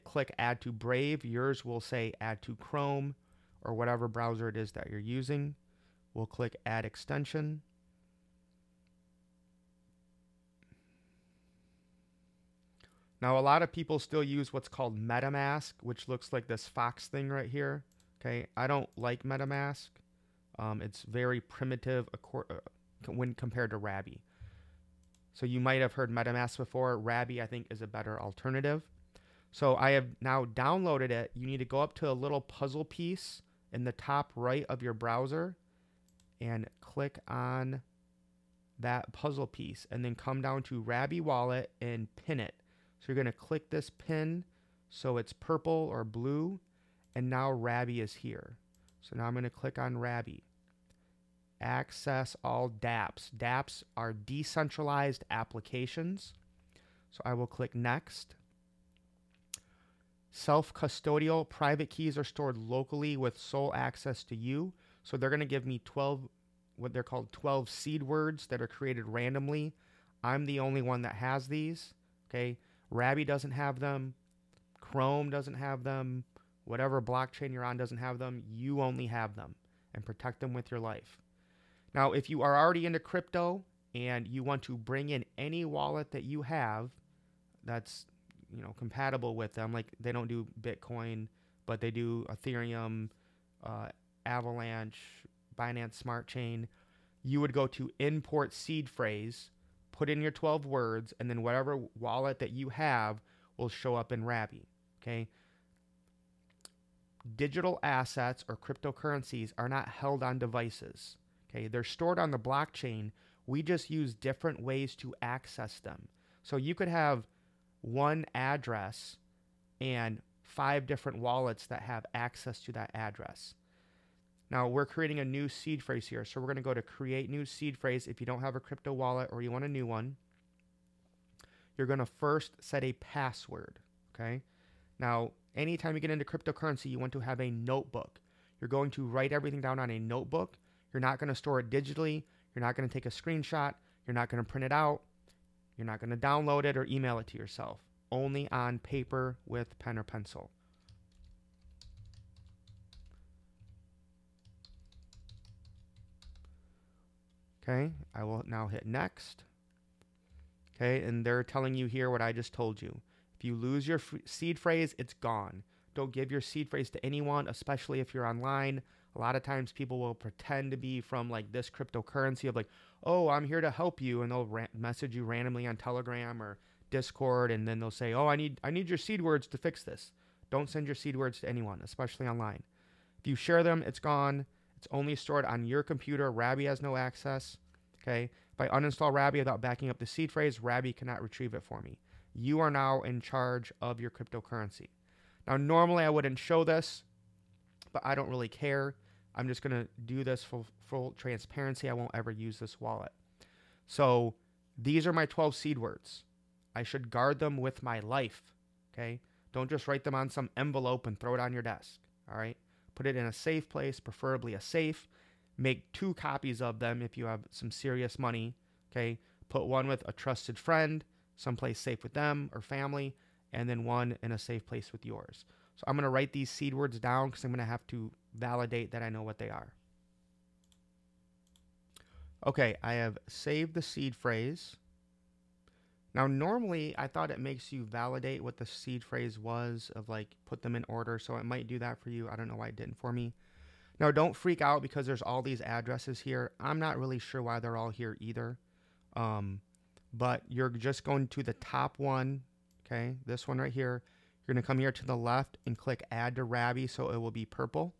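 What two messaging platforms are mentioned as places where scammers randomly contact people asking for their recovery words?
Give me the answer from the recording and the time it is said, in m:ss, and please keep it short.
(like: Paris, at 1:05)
Telegram or Discord, at 2:55.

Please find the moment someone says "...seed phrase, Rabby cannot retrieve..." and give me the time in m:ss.
3:10.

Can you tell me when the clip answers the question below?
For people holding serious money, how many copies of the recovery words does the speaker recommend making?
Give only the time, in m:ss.
3:35.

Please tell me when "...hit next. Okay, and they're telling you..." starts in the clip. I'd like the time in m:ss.
2:38.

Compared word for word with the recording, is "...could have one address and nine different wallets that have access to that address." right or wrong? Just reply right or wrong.
wrong.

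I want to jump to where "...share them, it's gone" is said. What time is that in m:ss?
3:03.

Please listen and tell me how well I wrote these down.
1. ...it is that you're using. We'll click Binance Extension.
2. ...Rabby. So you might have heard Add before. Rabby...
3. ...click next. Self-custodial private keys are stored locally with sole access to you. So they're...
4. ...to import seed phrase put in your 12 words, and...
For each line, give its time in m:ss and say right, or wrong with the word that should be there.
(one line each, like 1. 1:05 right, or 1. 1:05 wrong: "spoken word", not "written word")
1. 0:04 wrong: "Add", not "Binance"
2. 0:23 wrong: "MetaMask", not "Add"
3. 0:57 right
4. 1:37 right.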